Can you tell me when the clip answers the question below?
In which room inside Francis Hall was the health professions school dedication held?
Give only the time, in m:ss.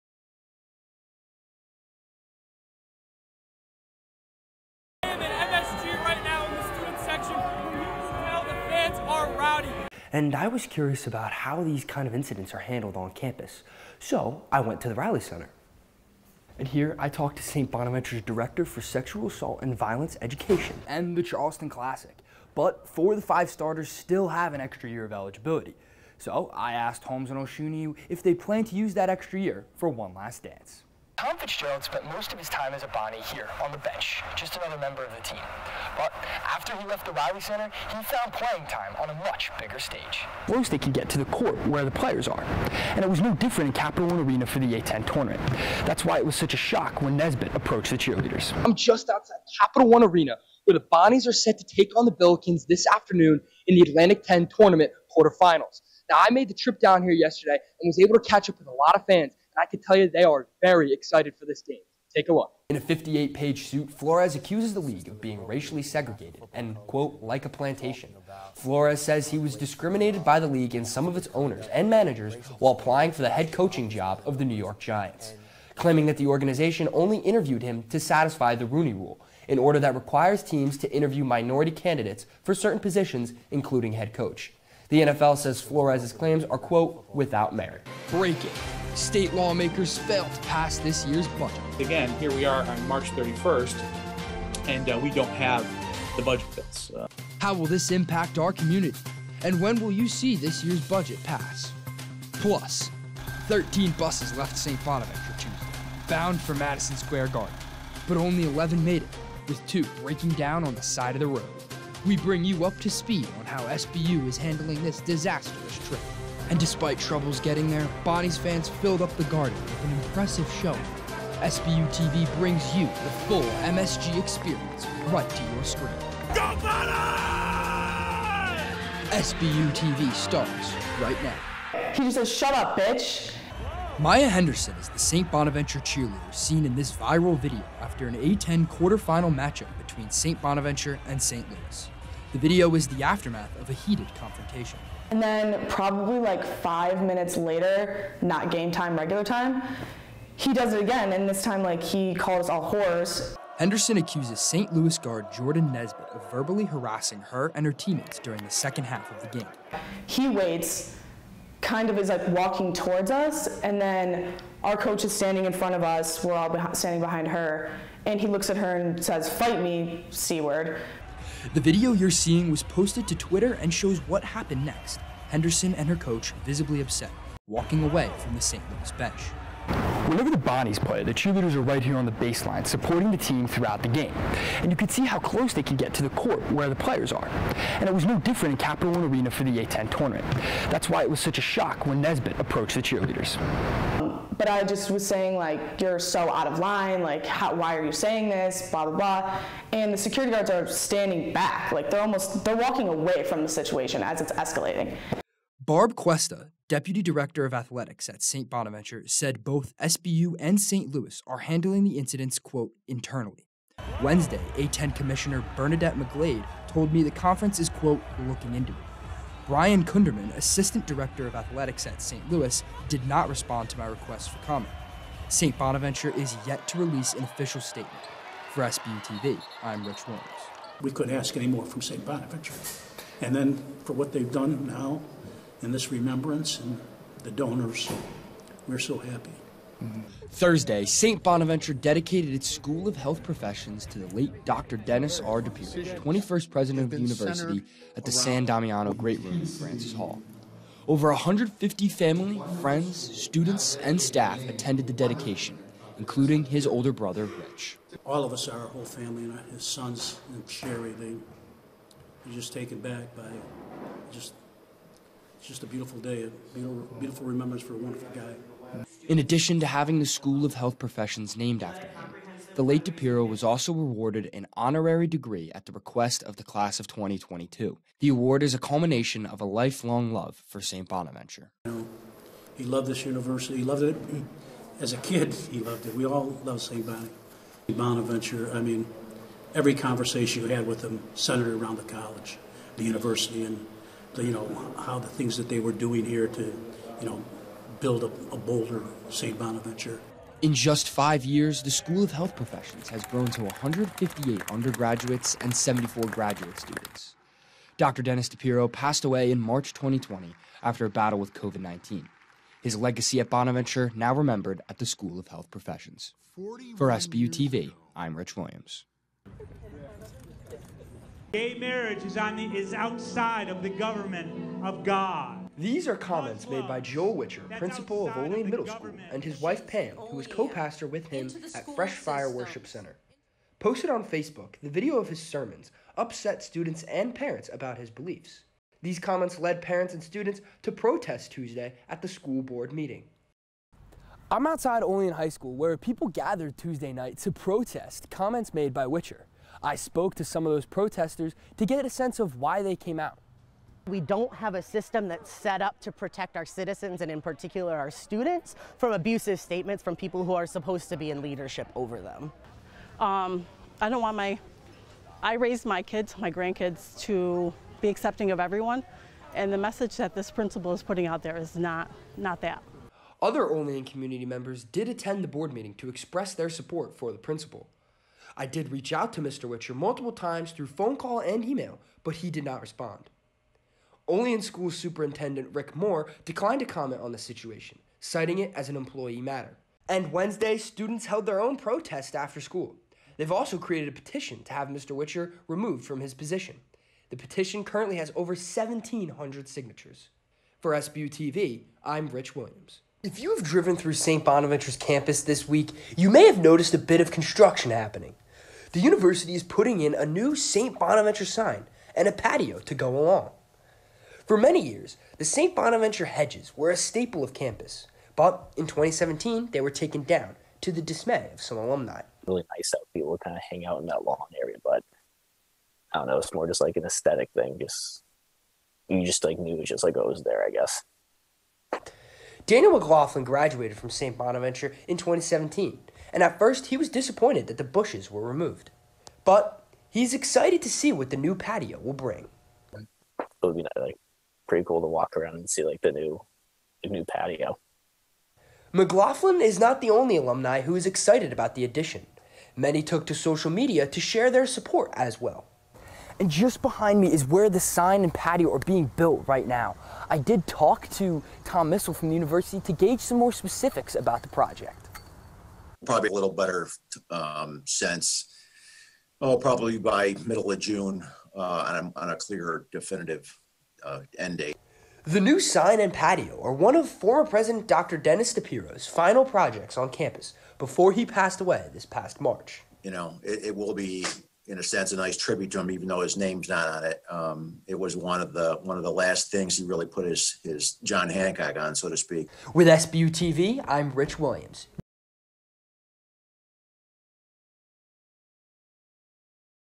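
4:08.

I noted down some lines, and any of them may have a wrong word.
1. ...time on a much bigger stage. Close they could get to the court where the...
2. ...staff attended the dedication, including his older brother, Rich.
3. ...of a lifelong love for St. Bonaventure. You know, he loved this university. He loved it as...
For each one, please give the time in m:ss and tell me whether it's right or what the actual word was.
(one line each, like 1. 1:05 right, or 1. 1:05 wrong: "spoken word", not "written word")
1. 0:38 right
2. 4:14 right
3. 4:39 right.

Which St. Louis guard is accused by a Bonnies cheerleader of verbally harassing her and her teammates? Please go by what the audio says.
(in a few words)
Jordan Nesbitt.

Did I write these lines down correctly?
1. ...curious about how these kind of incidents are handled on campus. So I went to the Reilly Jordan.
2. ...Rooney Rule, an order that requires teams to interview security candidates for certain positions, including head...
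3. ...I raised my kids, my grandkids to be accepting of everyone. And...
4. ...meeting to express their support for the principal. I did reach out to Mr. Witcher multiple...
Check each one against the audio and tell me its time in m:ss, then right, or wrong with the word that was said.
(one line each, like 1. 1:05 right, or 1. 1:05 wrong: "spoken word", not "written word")
1. 0:10 wrong: "Center", not "Jordan"
2. 1:18 wrong: "minority", not "security"
3. 6:05 right
4. 6:15 right.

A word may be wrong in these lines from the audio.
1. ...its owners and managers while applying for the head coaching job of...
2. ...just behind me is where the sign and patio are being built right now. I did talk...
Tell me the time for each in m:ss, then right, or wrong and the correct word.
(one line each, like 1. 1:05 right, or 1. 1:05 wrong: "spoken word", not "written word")
1. 1:11 right
2. 7:36 right.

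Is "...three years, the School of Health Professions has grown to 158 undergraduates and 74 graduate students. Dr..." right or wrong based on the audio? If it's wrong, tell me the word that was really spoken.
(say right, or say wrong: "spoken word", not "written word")
wrong: "five", not "three".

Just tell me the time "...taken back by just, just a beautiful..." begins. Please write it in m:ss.
4:22.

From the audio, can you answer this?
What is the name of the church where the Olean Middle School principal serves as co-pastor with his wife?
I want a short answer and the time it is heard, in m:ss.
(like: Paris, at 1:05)
Fresh Fire Worship Center, at 5:31.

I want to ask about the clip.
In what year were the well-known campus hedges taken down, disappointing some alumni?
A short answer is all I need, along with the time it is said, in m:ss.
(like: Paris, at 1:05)
2017, at 6:58.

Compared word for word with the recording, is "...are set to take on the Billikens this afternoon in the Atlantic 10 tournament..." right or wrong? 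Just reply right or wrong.
right.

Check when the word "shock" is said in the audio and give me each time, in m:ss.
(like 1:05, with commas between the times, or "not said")
0:46, 3:11.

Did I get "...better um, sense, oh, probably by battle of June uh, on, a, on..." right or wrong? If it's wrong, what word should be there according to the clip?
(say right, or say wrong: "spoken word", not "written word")
wrong: "middle", not "battle".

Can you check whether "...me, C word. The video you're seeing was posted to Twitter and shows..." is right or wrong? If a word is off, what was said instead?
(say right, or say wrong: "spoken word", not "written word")
right.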